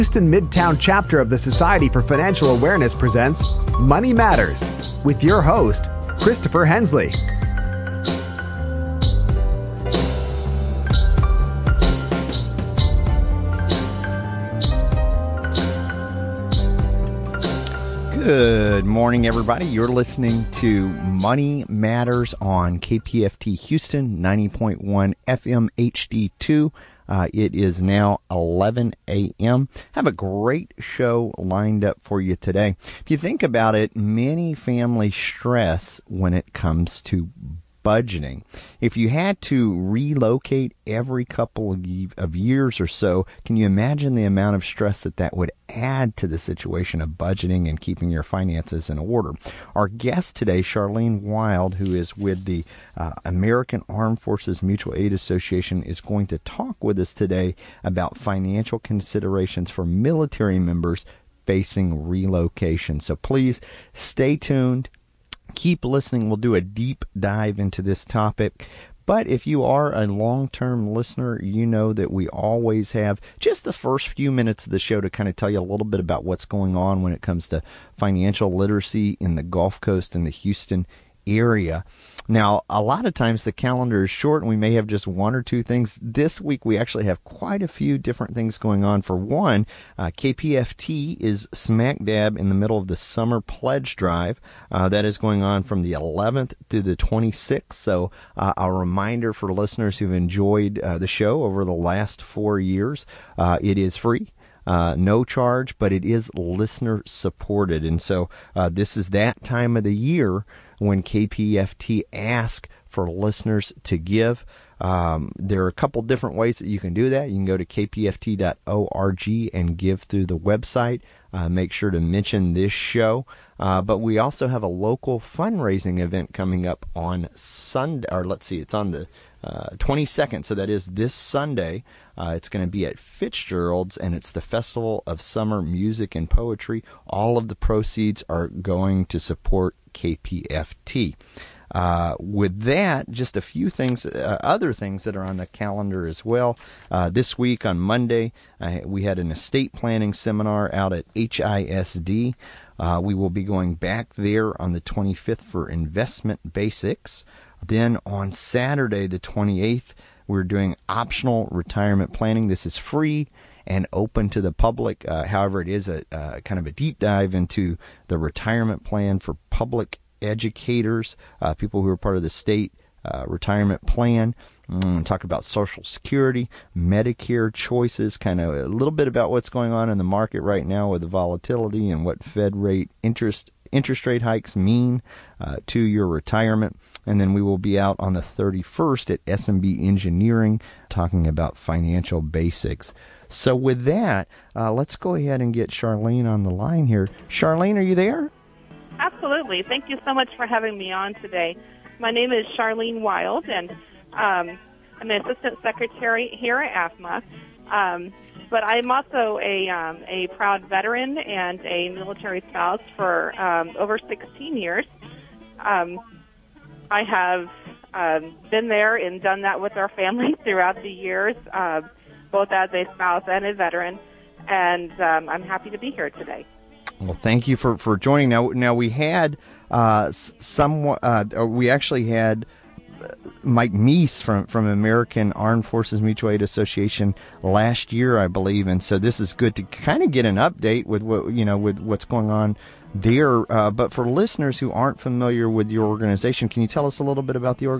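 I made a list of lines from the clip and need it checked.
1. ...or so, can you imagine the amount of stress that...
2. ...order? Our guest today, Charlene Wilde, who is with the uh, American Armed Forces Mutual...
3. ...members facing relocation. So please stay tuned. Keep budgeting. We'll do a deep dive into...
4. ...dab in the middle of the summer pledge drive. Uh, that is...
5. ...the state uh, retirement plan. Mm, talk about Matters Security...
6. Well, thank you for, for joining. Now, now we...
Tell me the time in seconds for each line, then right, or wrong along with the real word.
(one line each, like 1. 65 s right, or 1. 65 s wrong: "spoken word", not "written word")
1. 42 s right
2. 48 s right
3. 60 s wrong: "listening", not "budgeting"
4. 92 s right
5. 172 s wrong: "Social", not "Matters"
6. 226 s right.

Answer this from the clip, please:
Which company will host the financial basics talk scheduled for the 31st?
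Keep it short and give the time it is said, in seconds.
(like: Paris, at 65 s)
SMB Engineering, at 189 s.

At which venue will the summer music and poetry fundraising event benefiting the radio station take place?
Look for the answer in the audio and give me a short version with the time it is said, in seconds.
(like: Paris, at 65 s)
Fitzgerald's, at 132 s.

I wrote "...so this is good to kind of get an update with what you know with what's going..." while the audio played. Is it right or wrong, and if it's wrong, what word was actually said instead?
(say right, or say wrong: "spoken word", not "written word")
right.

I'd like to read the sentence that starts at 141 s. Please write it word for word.
Uh, with that, just a few things, uh, other things that are on the calendar as well.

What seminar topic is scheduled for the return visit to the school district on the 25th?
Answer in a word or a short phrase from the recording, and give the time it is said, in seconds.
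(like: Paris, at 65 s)
investment basics, at 155 s.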